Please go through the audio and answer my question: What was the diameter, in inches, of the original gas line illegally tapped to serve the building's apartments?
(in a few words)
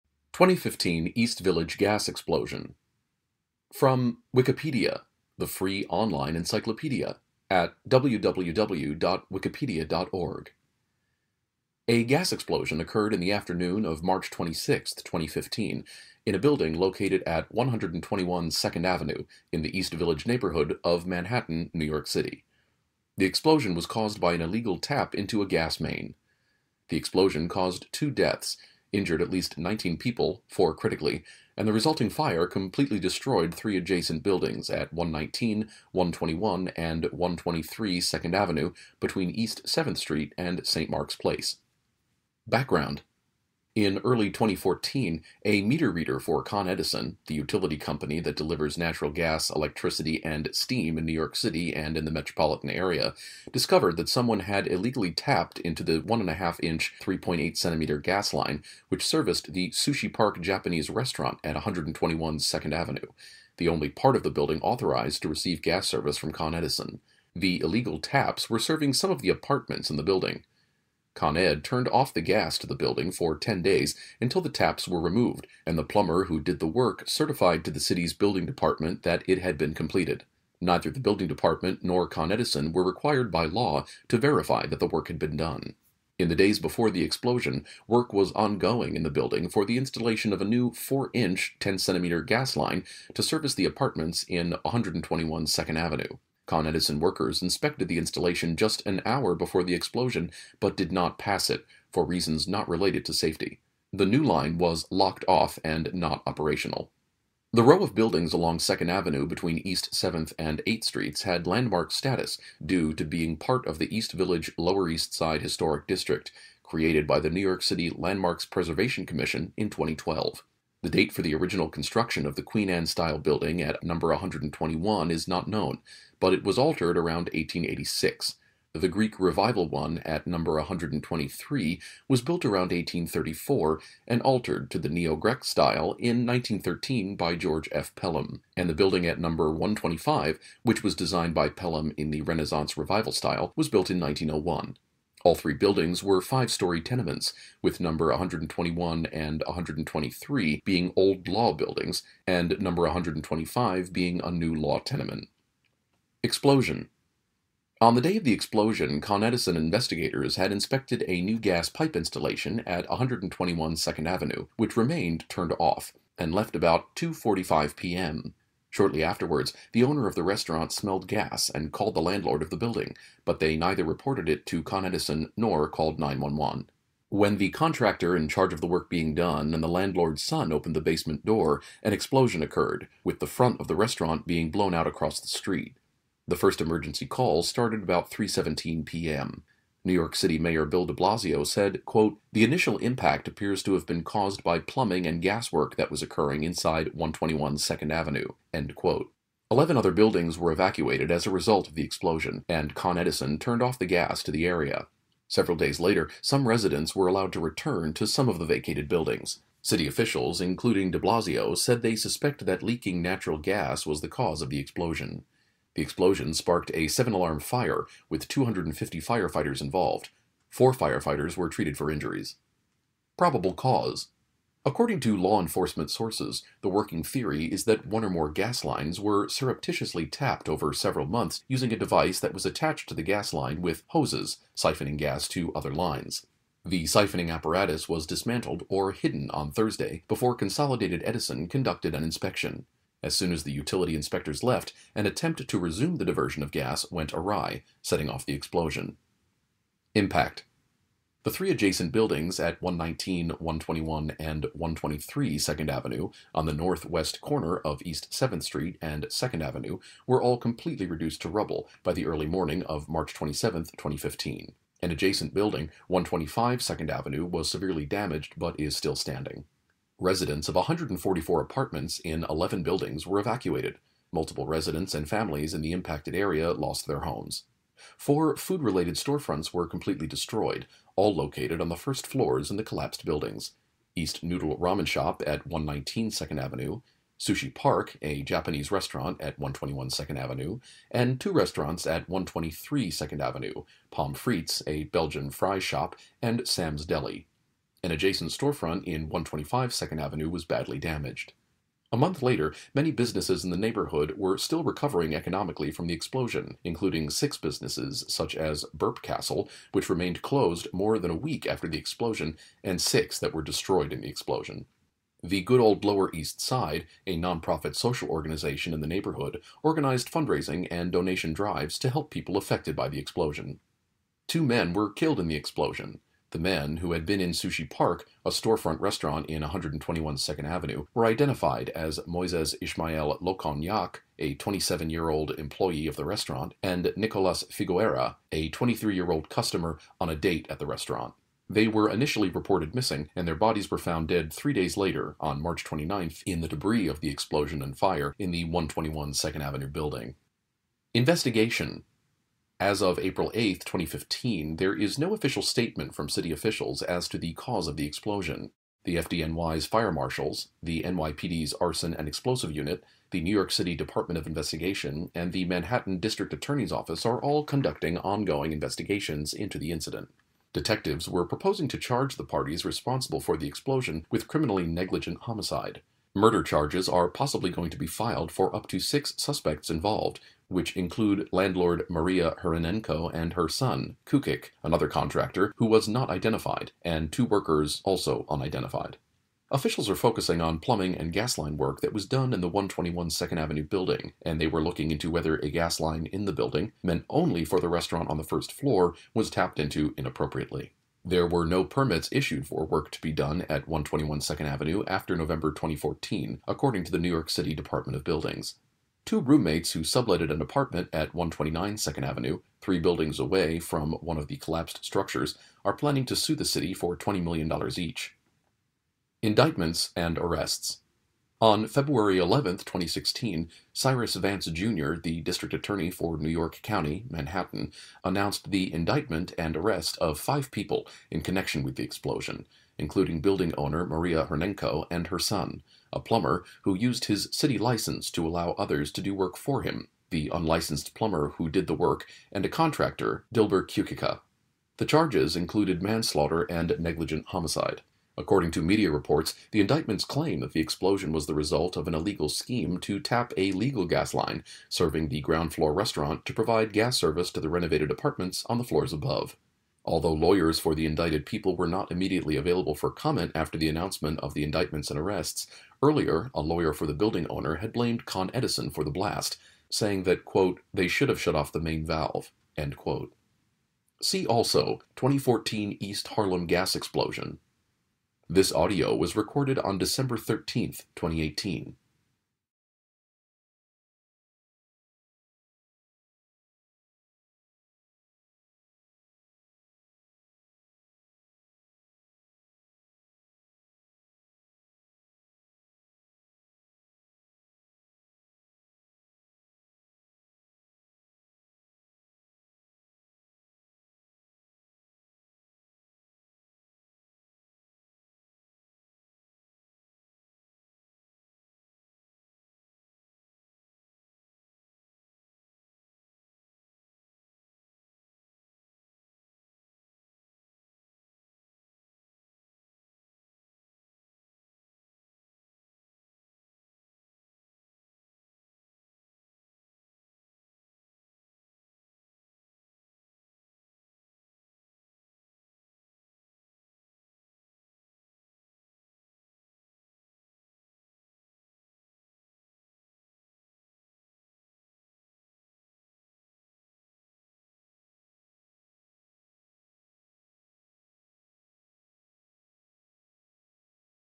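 1.5 inch.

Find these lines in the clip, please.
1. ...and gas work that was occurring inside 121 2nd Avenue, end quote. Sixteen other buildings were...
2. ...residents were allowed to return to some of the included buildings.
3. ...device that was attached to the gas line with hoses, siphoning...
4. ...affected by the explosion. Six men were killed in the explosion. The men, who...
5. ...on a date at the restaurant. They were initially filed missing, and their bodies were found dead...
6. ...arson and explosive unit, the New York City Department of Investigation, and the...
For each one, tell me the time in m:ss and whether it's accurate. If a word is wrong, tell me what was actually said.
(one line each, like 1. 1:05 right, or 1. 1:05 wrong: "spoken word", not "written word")
1. 3:15 wrong: "Eleven", not "Sixteen"
2. 3:26 wrong: "vacated", not "included"
3. 3:51 right
4. 5:22 wrong: "Two", not "Six"
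5. 5:39 wrong: "reported", not "filed"
6. 6:01 right.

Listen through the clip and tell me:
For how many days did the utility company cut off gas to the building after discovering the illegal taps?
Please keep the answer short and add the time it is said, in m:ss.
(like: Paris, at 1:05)
10 days, at 1:13.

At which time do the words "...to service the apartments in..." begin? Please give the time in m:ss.
1:33.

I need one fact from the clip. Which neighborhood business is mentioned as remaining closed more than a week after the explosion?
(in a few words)
Burp Castle.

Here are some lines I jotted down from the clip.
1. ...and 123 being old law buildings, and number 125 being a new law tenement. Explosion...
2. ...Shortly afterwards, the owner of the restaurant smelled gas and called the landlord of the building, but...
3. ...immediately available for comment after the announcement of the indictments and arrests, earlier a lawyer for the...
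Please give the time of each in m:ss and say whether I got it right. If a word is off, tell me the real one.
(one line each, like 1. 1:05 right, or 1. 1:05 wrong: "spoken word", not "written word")
1. 2:29 right
2. 2:48 right
3. 7:41 right.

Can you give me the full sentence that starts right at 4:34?
Multiple residents and families in the impacted area lost their homes.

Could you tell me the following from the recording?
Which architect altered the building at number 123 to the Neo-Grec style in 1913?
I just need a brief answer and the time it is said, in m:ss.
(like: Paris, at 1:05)
George F. Pelham, at 2:17.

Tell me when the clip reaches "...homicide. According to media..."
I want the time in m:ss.
7:27.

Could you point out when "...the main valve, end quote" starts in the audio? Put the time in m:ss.
7:51.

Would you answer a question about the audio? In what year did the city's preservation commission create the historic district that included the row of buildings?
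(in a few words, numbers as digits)
2012.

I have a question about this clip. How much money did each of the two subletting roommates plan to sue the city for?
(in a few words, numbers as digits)
$20 million.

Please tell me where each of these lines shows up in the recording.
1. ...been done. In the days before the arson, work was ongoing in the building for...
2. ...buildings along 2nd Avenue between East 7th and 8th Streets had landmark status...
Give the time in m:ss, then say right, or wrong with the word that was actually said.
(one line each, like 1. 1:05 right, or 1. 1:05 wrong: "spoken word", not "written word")
1. 1:25 wrong: "explosion", not "arson"
2. 1:47 right.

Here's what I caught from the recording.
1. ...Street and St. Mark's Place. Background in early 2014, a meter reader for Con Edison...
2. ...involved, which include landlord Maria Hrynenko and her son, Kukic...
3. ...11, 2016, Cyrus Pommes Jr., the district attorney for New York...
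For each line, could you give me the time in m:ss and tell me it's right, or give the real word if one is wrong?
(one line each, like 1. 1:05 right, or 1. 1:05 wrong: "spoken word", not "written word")
1. 0:39 right
2. 6:19 right
3. 7:02 wrong: "Vance", not "Pommes".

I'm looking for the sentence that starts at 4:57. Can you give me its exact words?
An adjacent storefront in 125 Second Avenue was badly damaged.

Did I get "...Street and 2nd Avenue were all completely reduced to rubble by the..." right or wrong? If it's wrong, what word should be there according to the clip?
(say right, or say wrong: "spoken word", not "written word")
right.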